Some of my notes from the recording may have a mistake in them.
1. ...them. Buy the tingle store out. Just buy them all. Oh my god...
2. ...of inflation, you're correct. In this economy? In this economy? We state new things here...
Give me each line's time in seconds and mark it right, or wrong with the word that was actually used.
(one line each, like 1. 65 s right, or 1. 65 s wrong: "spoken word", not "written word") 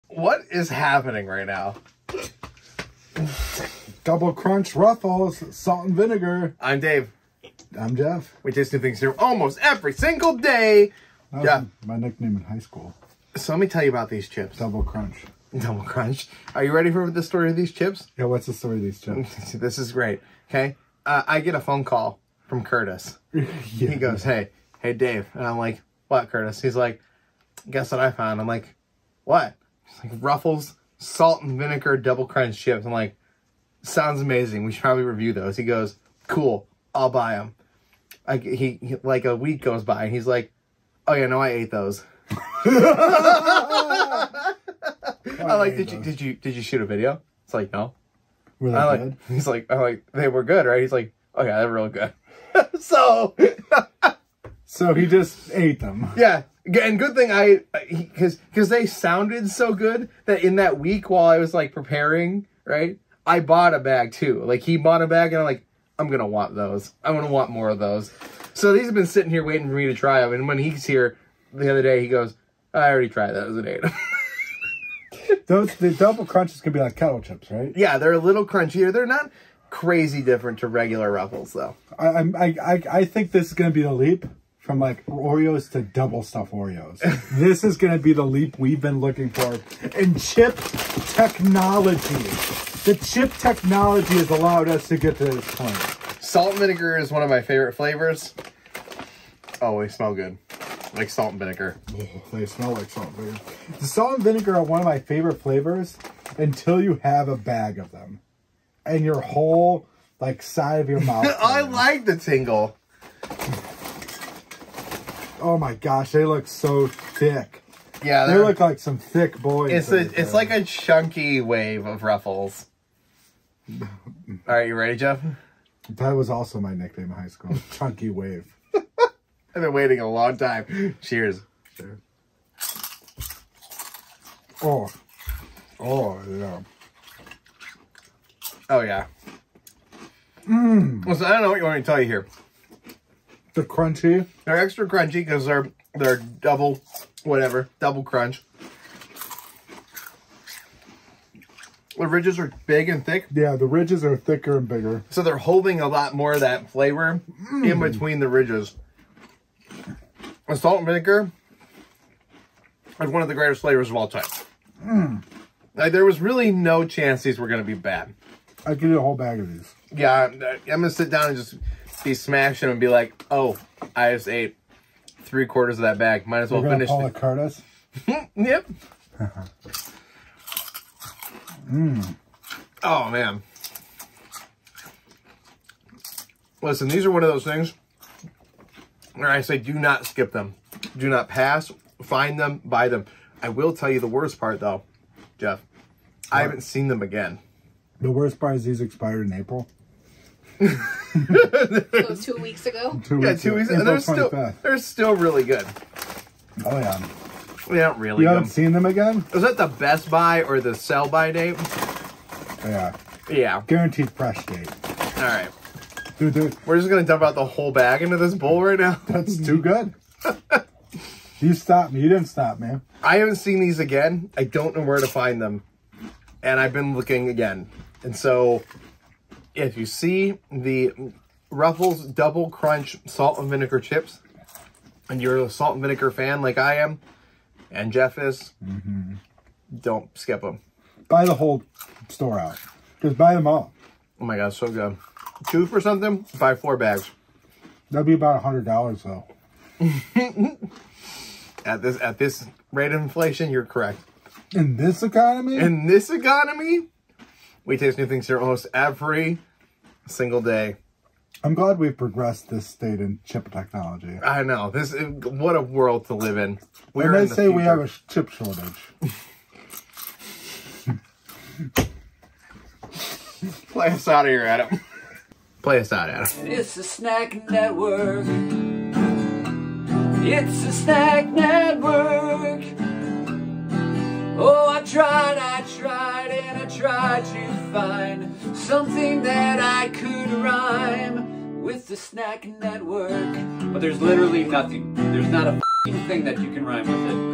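1. 240 s wrong: "whole", not "tingle"
2. 252 s wrong: "taste", not "state".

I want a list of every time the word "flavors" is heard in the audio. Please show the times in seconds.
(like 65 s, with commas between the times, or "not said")
97 s, 105 s, 156 s, 163 s.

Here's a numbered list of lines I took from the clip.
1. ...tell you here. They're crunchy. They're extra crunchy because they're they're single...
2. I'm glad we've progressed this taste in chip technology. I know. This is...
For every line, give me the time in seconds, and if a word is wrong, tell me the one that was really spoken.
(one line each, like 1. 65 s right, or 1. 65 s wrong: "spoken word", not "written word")
1. 141 s wrong: "double", not "single"
2. 261 s wrong: "state", not "taste".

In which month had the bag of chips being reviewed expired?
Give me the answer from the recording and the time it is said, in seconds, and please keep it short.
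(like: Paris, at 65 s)
April, at 199 s.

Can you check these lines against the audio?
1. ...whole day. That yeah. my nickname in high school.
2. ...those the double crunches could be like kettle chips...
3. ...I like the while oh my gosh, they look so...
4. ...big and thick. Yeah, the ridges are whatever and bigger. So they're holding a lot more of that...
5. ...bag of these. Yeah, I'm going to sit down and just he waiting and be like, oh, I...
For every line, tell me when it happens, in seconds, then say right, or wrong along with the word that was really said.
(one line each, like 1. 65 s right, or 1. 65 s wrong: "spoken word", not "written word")
1. 9 s wrong: "single", not "whole"
2. 75 s right
3. 111 s wrong: "tingle", not "while"
4. 152 s wrong: "thicker", not "whatever"
5. 169 s wrong: "smashing", not "waiting".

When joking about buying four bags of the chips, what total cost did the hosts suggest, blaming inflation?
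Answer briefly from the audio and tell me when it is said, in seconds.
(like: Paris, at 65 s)
$100, at 248 s.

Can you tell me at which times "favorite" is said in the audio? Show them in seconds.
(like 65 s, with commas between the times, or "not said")
97 s, 104 s.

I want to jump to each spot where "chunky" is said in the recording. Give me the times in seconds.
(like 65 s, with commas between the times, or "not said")
120 s, 127 s.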